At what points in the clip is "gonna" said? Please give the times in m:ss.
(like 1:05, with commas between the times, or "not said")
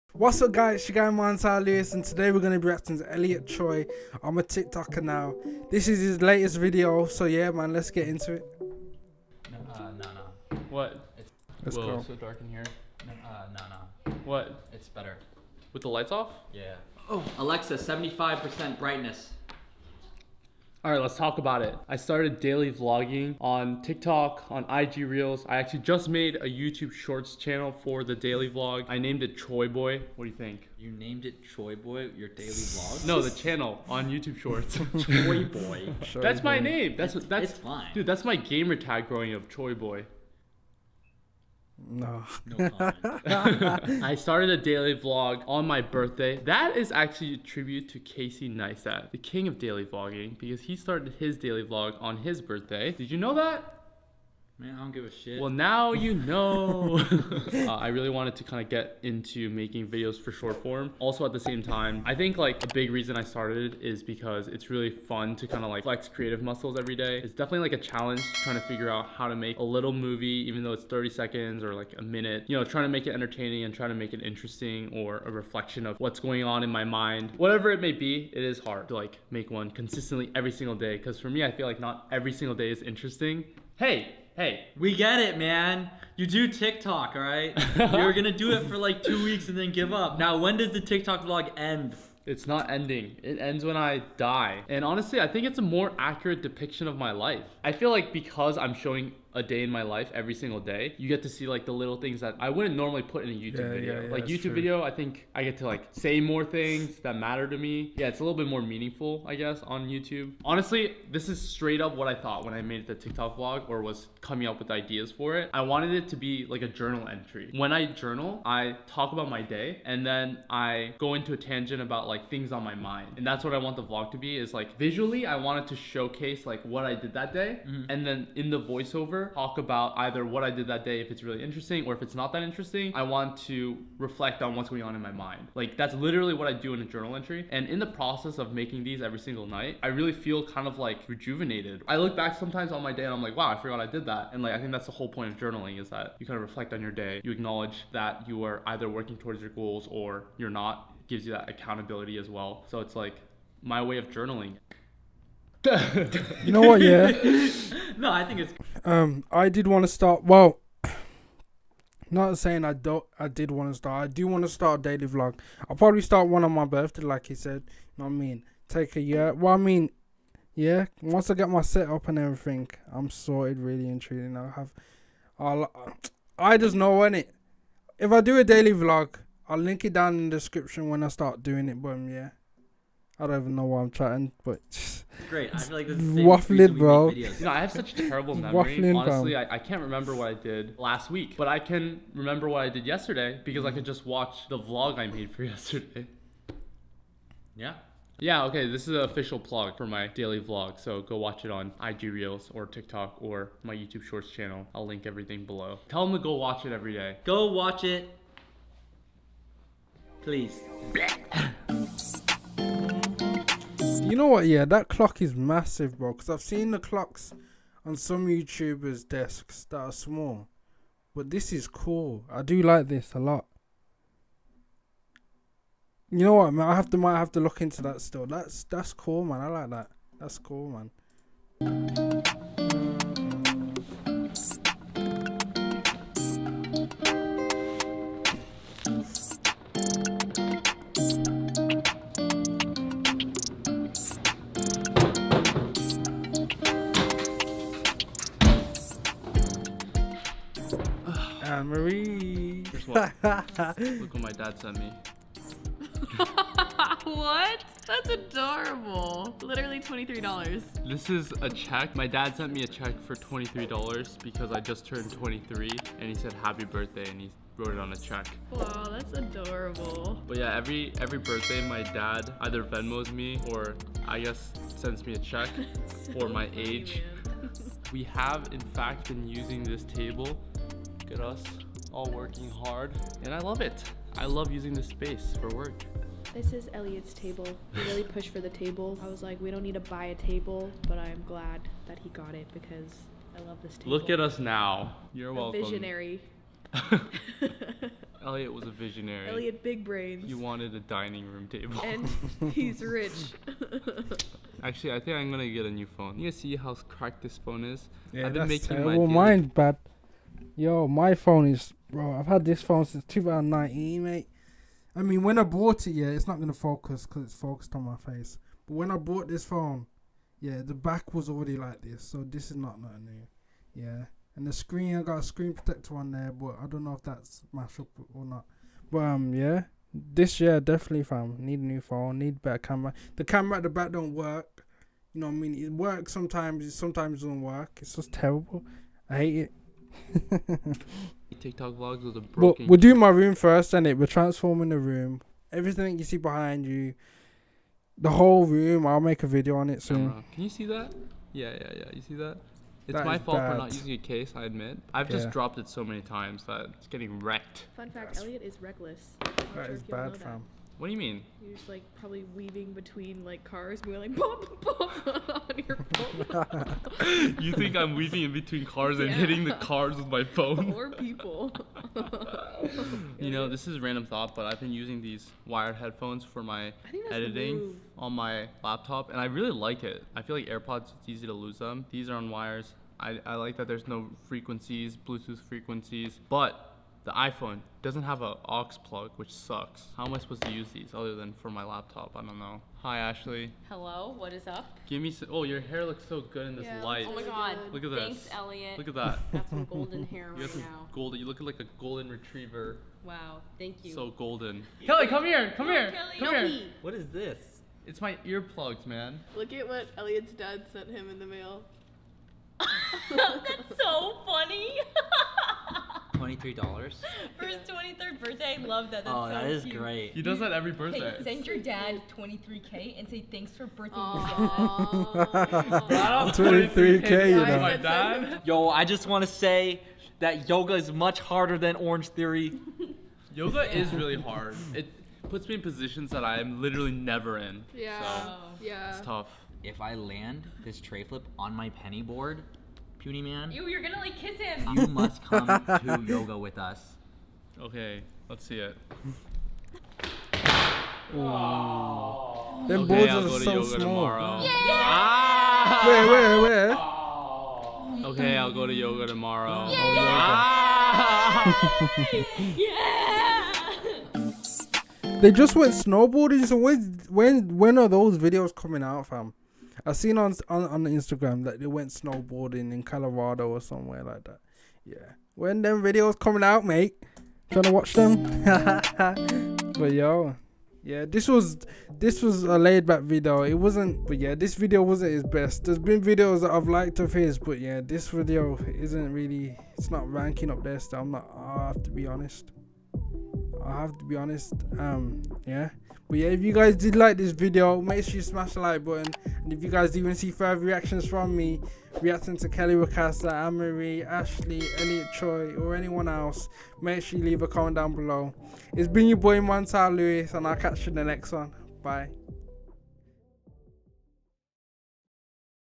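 1:28, 5:05, 5:16, 7:23.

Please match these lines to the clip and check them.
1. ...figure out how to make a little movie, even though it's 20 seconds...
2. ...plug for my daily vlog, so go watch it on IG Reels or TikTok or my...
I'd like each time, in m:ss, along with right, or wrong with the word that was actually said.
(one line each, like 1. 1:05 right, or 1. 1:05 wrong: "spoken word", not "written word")
1. 1:08 wrong: "30", not "20"
2. 3:19 right.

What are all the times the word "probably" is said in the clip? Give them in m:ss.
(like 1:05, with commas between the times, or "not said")
2:45, 6:01.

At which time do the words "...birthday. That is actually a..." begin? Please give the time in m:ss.
0:45.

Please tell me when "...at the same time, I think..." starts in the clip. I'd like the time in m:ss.
1:01.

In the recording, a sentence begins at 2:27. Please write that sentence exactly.
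You acknowledge that you are either working towards your goals or you're not.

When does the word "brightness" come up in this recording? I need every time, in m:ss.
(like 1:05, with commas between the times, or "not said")
0:18.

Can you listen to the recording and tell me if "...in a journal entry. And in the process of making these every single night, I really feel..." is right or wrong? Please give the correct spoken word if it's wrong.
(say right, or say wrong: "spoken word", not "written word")
right.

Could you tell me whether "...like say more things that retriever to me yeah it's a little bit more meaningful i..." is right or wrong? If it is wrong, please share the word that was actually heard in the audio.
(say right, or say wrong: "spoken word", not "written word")
wrong: "matter", not "retriever".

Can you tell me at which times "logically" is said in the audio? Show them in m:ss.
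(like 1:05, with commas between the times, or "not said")
not said.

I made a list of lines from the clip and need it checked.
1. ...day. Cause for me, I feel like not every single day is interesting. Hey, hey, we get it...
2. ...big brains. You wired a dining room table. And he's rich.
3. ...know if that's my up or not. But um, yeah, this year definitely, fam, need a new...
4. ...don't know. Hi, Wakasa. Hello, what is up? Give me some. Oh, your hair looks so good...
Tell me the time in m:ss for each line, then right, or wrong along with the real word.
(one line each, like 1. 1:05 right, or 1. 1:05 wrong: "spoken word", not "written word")
1. 1:20 right
2. 4:59 wrong: "wanted", not "wired"
3. 5:26 right
4. 6:32 wrong: "Ashley", not "Wakasa".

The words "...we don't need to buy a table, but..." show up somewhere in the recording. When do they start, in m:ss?
4:49.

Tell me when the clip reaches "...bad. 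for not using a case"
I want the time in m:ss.
5:53.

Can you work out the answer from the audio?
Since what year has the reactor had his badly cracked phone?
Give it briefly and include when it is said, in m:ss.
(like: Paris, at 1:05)
2019, at 5:13.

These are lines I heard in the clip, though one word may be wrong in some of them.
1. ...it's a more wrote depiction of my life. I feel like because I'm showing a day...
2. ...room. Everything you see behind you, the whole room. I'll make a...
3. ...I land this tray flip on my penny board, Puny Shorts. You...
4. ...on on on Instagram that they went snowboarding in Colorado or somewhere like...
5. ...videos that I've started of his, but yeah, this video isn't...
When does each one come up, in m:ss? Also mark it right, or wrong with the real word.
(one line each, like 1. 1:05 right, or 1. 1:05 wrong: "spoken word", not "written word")
1. 1:35 wrong: "accurate", not "wrote"
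2. 5:44 right
3. 7:19 wrong: "Man", not "Shorts"
4. 7:50 right
5. 8:06 wrong: "liked", not "started".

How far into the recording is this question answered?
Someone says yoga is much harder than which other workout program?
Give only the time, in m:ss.
7:11.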